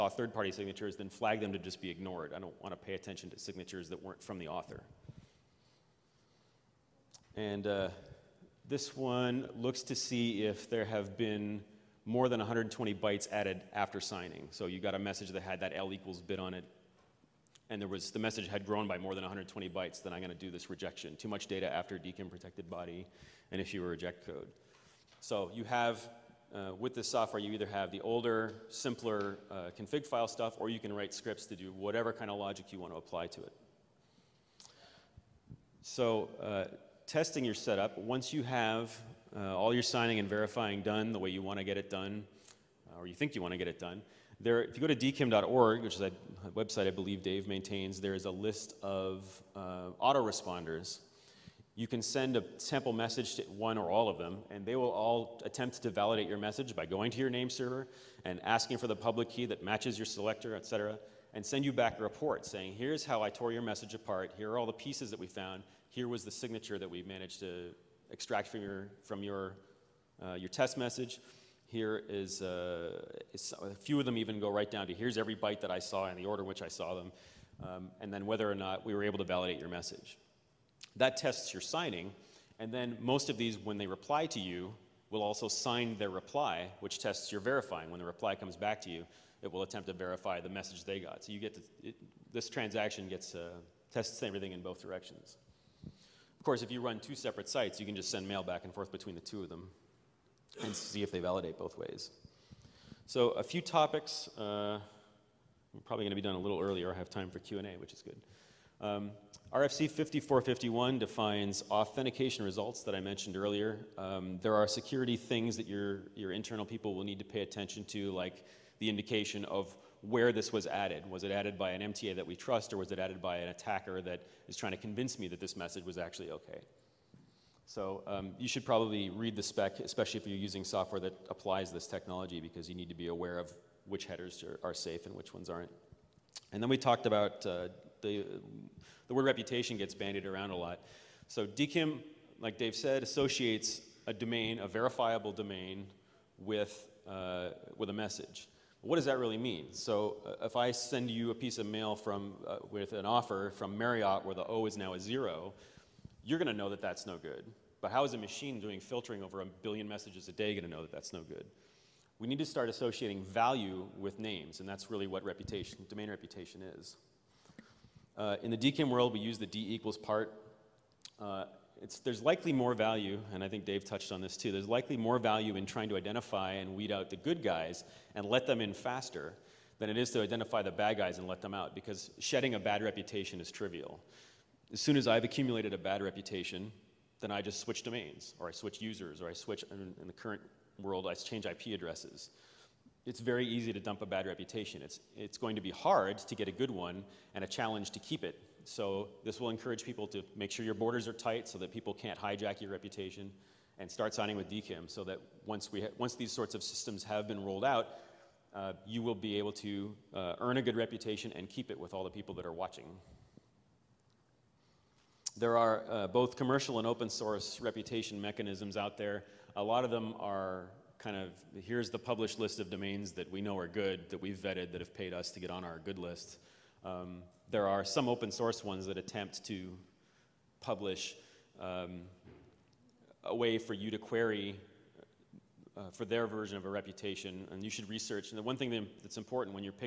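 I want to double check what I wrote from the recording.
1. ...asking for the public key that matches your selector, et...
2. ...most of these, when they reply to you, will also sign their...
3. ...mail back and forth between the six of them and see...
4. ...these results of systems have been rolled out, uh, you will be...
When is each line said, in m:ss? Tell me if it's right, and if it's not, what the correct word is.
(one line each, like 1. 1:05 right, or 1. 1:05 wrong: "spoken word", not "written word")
1. 0:58 right
2. 1:22 right
3. 1:38 wrong: "two", not "six"
4. 3:26 wrong: "sorts", not "results".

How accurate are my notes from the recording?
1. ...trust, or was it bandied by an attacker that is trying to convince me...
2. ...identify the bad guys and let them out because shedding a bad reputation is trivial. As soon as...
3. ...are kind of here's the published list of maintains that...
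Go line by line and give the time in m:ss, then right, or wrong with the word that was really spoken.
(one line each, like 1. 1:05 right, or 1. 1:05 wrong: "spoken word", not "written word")
1. 2:02 wrong: "added", not "bandied"
2. 3:00 right
3. 3:40 wrong: "domains", not "maintains".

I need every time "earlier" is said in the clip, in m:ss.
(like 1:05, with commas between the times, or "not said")
1:46, 1:53.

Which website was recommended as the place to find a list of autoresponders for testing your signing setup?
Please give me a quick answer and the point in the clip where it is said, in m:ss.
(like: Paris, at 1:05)
dkim.org, at 0:44.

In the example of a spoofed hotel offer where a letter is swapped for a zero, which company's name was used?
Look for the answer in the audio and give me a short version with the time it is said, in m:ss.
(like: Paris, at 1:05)
Marriott, at 2:33.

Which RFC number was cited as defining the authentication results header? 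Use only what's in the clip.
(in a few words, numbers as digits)
5451.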